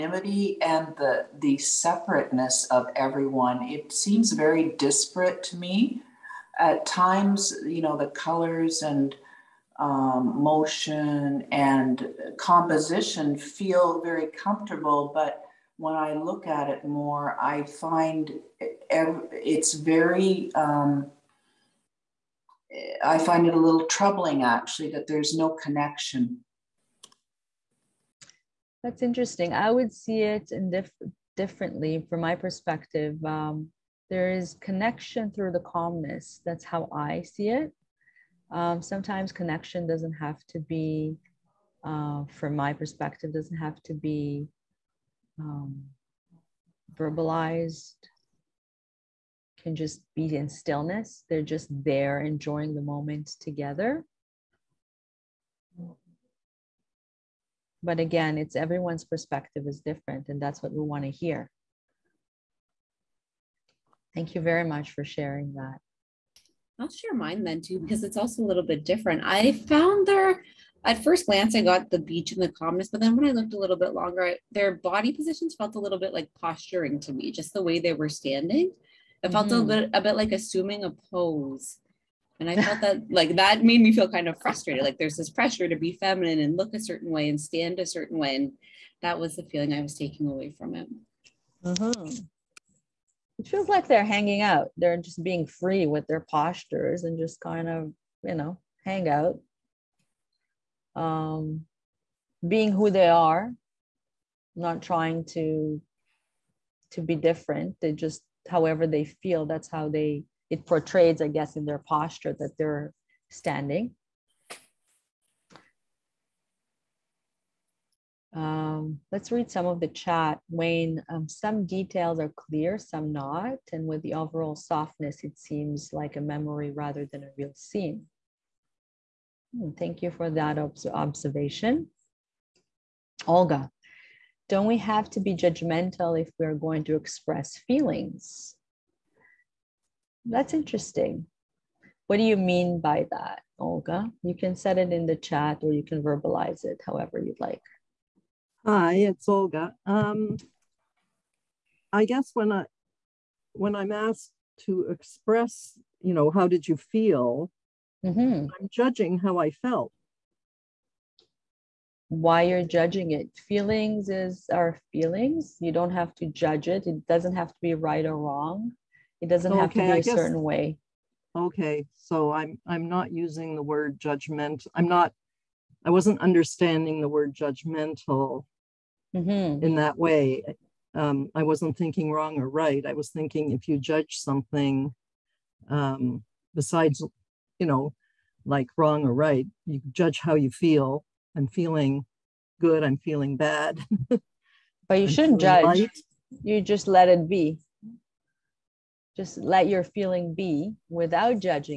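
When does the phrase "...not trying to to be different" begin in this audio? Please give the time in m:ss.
1:44.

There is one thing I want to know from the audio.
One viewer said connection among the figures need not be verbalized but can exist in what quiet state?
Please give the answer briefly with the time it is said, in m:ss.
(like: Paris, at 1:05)
stillness, at 0:50.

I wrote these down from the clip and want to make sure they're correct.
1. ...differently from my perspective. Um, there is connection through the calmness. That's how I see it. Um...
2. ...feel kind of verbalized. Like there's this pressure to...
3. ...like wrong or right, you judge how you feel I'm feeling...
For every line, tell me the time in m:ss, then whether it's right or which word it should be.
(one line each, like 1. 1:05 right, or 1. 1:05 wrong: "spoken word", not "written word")
1. 0:31 right
2. 1:23 wrong: "frustrated", not "verbalized"
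3. 3:08 right.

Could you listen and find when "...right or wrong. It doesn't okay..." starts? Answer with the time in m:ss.
2:47.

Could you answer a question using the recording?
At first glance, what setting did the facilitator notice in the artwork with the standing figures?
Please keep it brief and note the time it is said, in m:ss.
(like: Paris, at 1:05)
the beach, at 1:11.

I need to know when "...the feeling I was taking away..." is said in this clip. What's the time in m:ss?
1:29.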